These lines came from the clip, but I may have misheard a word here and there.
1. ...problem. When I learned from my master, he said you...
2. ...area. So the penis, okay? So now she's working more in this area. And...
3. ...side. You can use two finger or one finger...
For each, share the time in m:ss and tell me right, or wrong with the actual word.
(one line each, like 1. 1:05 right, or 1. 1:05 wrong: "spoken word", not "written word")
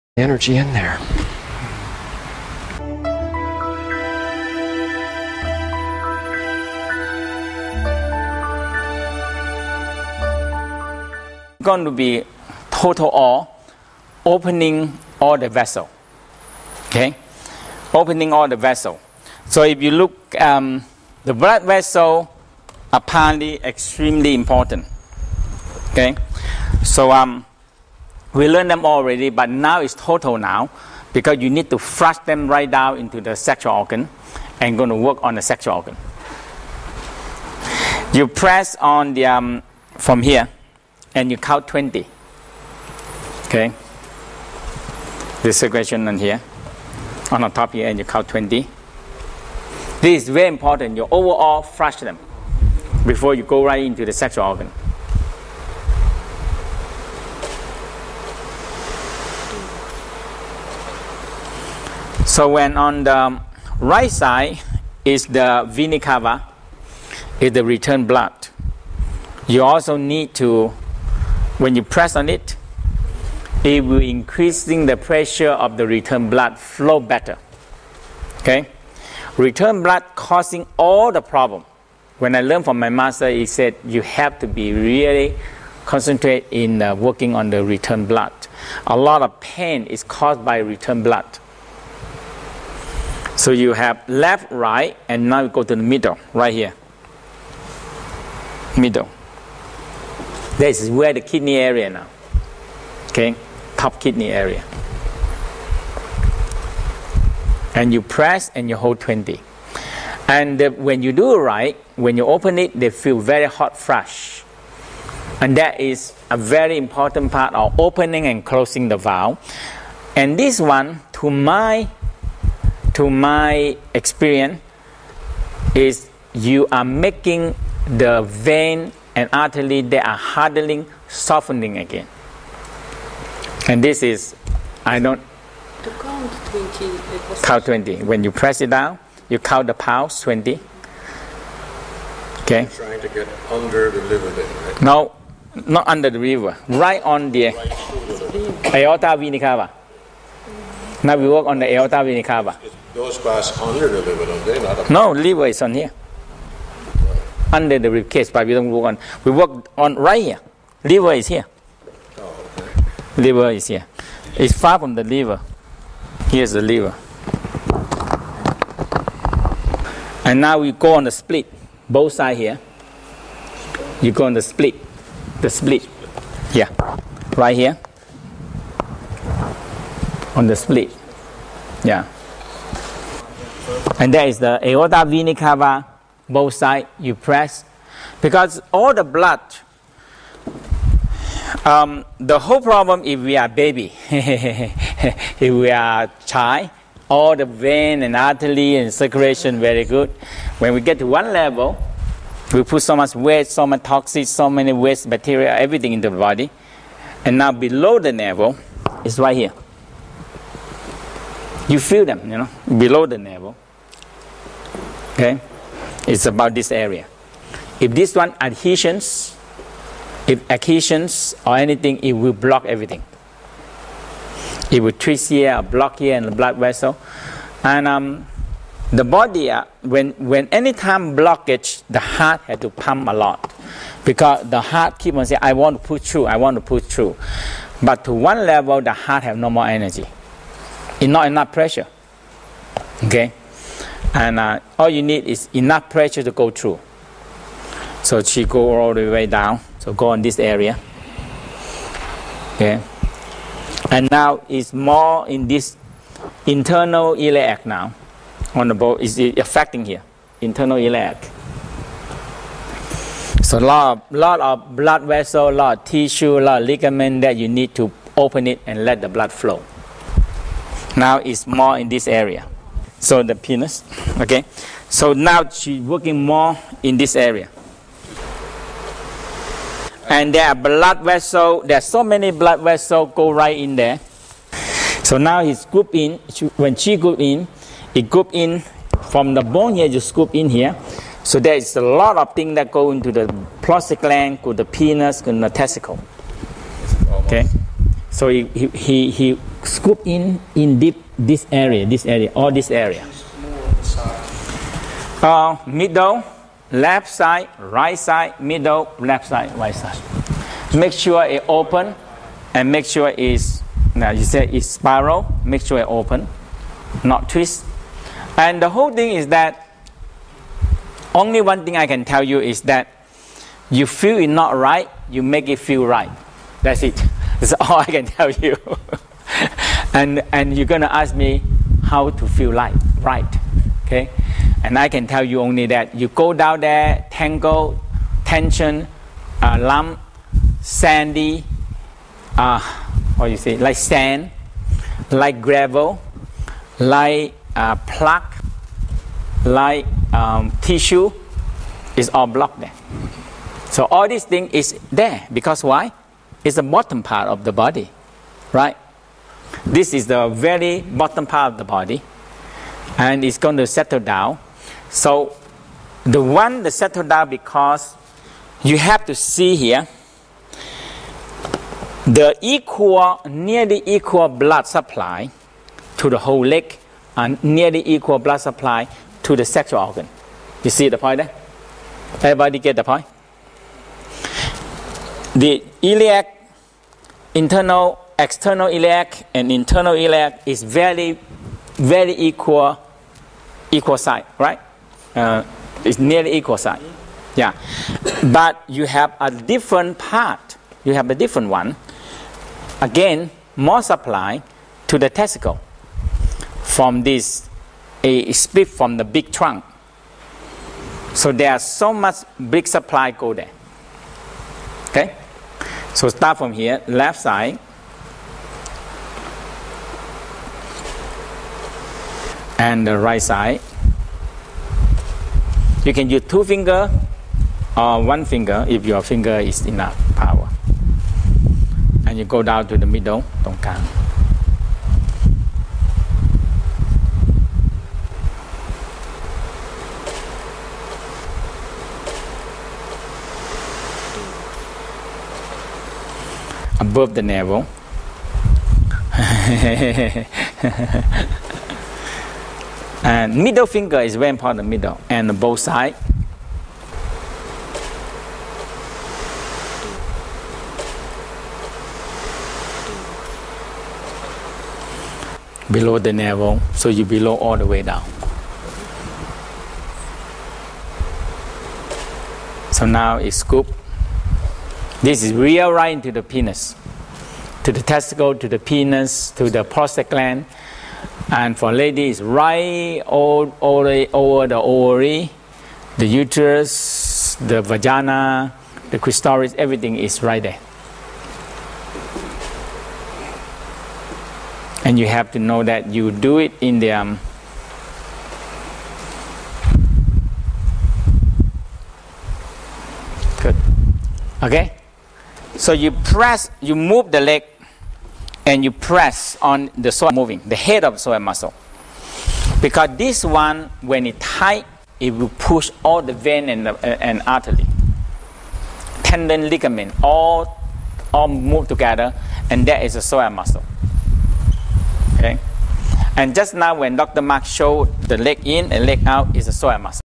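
1. 1:21 right
2. 4:32 right
3. 7:03 right.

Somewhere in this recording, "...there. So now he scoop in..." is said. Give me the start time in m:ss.
4:43.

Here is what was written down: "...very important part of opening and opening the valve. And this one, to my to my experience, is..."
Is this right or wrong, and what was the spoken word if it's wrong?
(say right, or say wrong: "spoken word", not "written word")
wrong: "closing", not "opening".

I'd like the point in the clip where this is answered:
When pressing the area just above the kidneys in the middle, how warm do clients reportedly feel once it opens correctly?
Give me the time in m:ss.
1:53.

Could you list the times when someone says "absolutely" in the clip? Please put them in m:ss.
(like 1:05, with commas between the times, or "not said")
not said.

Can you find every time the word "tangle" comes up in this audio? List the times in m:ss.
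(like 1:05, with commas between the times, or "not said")
5:37.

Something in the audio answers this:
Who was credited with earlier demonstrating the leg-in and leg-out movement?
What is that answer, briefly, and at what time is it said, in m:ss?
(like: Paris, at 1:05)
Dr. Mark, at 8:46.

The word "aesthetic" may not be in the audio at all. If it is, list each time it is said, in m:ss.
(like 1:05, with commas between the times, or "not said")
not said.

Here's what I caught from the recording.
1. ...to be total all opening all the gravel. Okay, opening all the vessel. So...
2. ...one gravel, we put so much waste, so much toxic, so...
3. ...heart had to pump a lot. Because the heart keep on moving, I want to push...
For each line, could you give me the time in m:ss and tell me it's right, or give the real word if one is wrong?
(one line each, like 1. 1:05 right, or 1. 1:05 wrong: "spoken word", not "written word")
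1. 0:11 wrong: "vessel", not "gravel"
2. 3:21 wrong: "level", not "gravel"
3. 3:52 wrong: "saying", not "moving".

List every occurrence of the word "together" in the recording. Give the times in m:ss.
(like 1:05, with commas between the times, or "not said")
8:41.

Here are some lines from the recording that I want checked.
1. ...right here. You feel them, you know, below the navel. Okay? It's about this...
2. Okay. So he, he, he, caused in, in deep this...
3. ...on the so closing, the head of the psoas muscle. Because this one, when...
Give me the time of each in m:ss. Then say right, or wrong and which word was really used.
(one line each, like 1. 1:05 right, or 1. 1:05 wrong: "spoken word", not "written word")
1. 3:29 right
2. 4:57 wrong: "scooped", not "caused"
3. 8:29 wrong: "moving", not "closing".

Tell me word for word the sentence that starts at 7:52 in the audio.
So now it's scoop this is real right into the penis, to the testicle, to the penis, to the prostate gland.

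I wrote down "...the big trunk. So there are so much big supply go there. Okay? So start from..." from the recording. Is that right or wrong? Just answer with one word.
right.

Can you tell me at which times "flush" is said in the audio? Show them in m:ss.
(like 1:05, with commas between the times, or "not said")
0:31, 0:51.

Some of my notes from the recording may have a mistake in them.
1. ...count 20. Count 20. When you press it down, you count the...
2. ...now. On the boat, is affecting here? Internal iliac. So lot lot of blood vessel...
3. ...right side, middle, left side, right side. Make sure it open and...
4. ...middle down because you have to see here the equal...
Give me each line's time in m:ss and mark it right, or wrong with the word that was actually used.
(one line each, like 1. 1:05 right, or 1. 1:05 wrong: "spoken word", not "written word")
1. 2:16 right
2. 4:17 right
3. 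5:07 right
4. 6:06 wrong: "settle", not "middle".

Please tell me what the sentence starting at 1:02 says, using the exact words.
So when on the right side is the vena cava, is the return blood.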